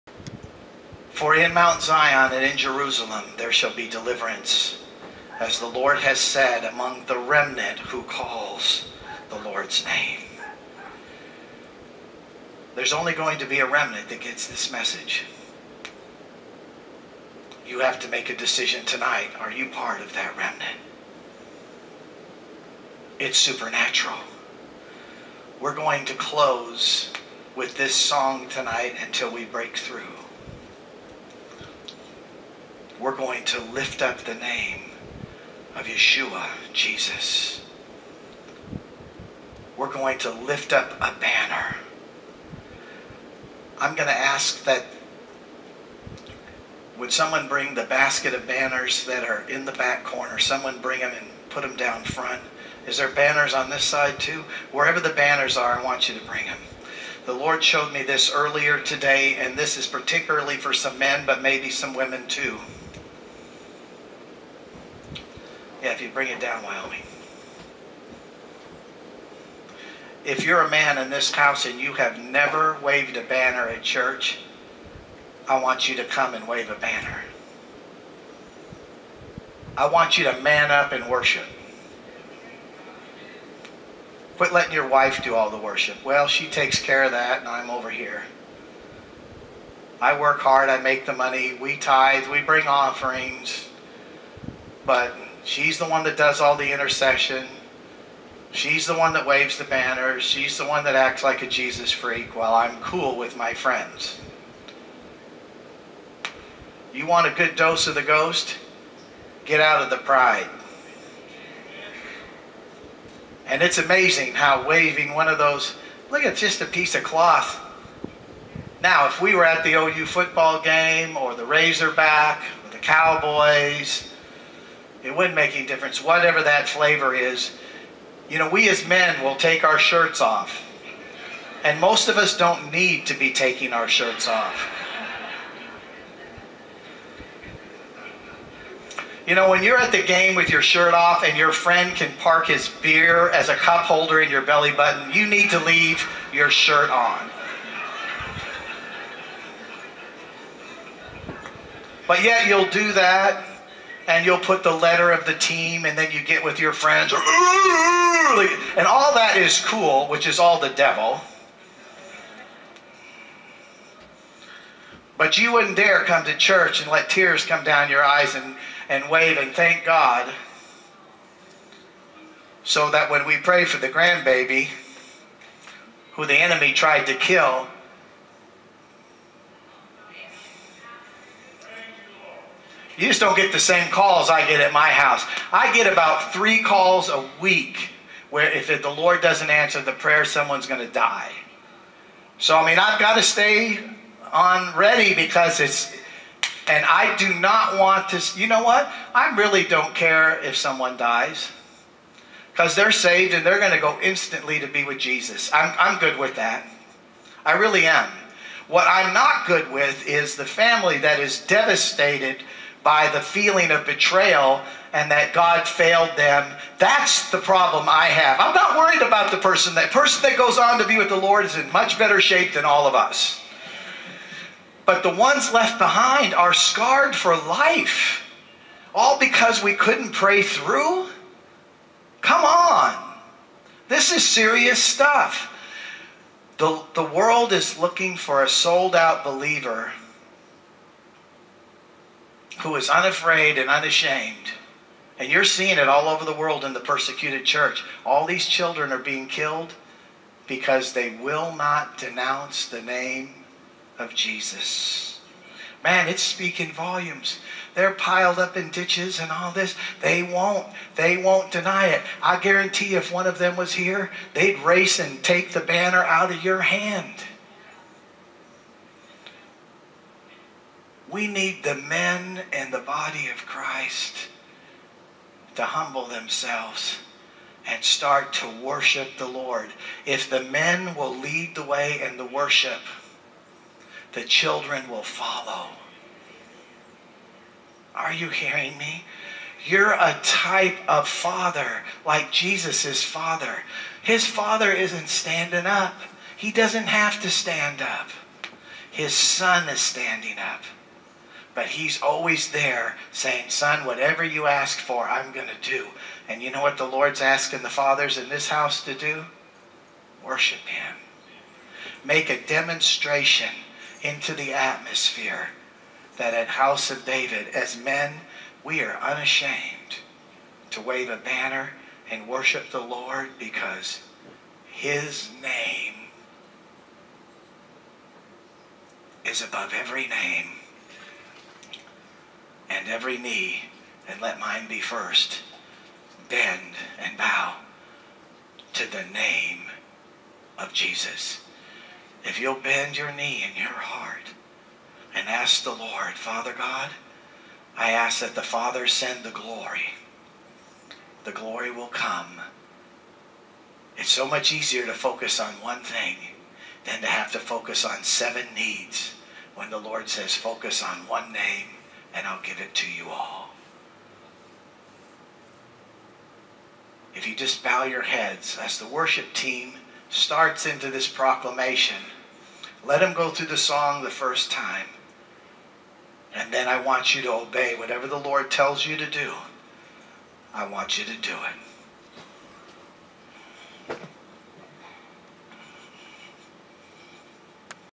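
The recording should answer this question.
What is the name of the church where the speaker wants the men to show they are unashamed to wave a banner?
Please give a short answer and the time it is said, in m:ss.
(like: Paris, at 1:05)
House of David, at 5:16.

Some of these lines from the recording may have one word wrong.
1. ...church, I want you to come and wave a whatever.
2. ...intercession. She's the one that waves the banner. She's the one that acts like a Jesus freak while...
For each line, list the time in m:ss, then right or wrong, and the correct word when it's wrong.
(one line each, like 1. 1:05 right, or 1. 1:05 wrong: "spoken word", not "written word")
1. 1:13 wrong: "banner", not "whatever"
2. 1:36 right.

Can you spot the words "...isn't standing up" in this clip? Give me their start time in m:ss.
4:54.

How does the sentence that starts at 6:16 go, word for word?
And then I want you to obey whatever the Lord tells you to do.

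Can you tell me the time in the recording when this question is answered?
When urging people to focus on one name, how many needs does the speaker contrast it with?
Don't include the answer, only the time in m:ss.
5:58.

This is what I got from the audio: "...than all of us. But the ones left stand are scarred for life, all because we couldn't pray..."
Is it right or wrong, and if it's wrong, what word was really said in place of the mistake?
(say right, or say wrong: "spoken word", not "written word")
wrong: "behind", not "stand".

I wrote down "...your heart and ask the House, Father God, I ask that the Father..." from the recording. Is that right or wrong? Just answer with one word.
wrong.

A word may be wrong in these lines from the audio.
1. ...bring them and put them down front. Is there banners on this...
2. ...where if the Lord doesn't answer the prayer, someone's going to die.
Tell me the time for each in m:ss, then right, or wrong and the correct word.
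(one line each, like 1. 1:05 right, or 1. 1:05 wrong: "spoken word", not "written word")
1. 0:50 right
2. 3:08 right.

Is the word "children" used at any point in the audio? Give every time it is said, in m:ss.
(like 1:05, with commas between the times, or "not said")
4:08, 4:44.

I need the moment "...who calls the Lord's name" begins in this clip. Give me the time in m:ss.
0:07.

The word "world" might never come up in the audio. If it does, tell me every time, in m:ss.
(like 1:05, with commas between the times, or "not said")
3:57, 4:06.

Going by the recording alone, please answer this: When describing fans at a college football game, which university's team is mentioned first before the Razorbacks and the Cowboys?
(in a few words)
OU.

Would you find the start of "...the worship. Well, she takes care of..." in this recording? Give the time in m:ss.
1:25.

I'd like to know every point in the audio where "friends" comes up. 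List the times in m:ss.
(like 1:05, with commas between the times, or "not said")
1:43, 2:21, 2:36.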